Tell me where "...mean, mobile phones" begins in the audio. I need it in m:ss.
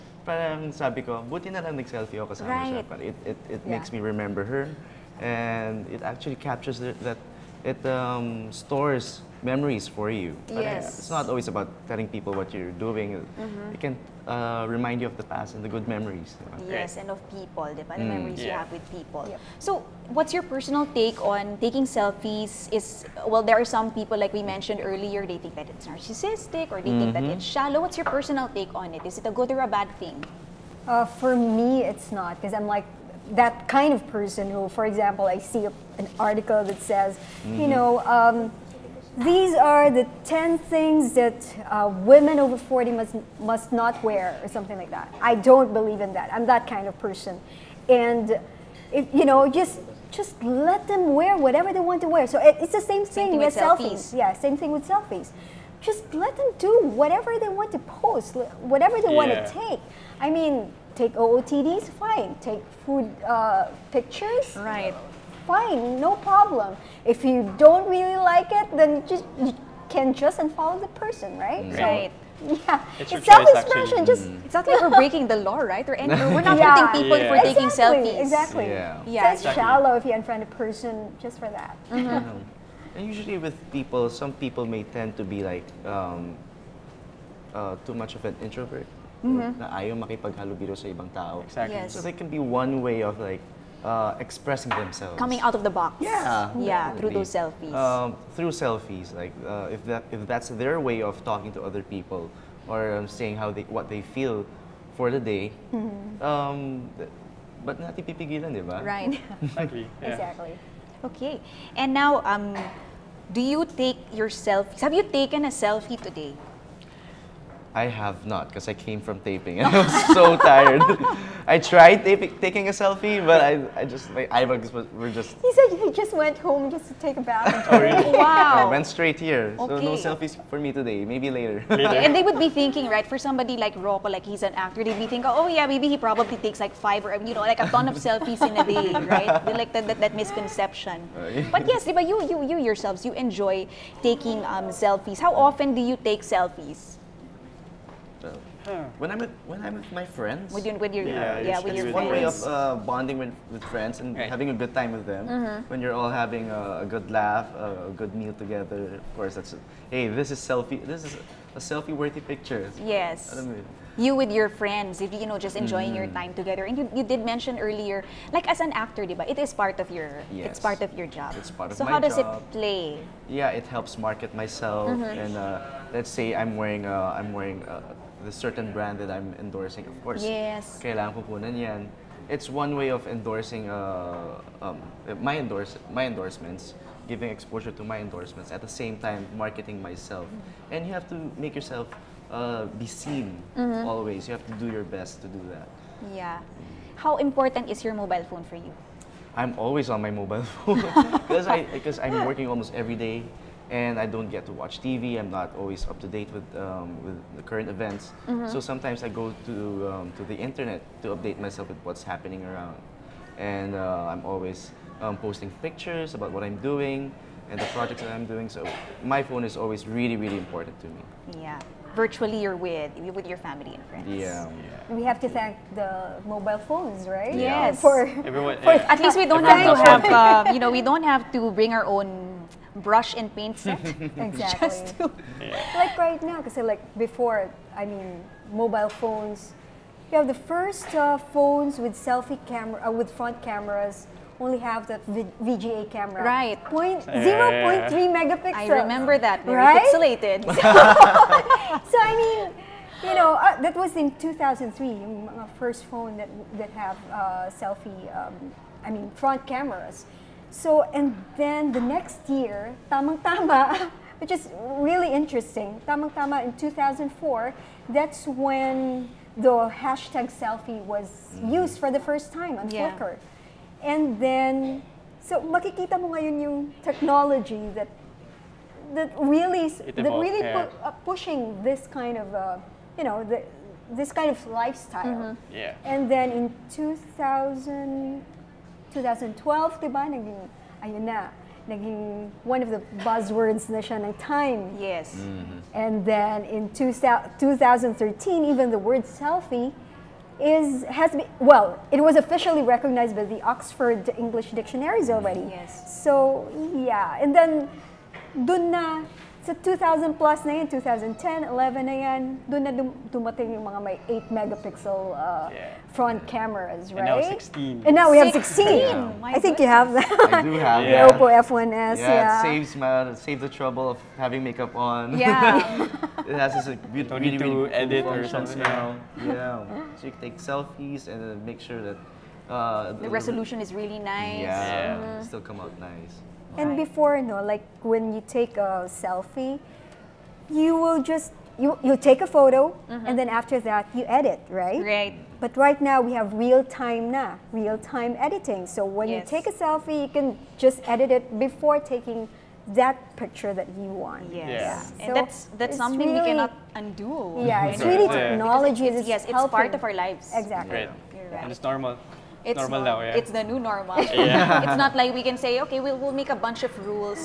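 3:57.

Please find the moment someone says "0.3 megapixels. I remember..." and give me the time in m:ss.
4:07.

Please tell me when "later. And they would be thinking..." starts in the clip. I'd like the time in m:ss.
2:11.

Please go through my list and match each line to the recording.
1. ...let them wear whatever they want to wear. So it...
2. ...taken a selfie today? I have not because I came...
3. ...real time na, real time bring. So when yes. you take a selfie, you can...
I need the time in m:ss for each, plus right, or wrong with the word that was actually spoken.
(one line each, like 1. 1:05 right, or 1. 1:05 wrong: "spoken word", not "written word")
1. 0:50 right
2. 1:55 right
3. 5:46 wrong: "editing", not "bring".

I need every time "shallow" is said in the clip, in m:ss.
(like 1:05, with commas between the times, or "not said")
0:27, 1:19.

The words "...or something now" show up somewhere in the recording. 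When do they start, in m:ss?
5:28.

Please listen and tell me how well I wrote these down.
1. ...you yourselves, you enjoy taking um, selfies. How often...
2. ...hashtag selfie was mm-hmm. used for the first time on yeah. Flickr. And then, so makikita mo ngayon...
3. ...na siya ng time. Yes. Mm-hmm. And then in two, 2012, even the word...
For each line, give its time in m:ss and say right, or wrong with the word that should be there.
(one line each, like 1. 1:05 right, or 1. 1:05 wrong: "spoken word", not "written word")
1. 2:22 right
2. 4:29 right
3. 4:53 wrong: "2013", not "2012".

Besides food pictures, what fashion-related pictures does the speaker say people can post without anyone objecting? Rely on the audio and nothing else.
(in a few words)
OOTDs.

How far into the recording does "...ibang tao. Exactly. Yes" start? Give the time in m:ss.
1:30.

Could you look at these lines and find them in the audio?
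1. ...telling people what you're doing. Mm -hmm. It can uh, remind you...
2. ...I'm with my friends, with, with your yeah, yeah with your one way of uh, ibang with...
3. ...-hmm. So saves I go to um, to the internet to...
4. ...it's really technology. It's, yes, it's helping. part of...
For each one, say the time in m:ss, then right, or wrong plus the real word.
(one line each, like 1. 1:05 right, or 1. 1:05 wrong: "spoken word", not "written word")
1. 0:11 right
2. 2:29 wrong: "bonding", not "ibang"
3. 3:28 wrong: "sometimes", not "saves"
4. 5:57 right.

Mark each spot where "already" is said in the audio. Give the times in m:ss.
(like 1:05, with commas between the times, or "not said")
5:05.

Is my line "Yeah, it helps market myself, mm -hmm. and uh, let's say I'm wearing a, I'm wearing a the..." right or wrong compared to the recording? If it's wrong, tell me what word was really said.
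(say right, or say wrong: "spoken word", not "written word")
right.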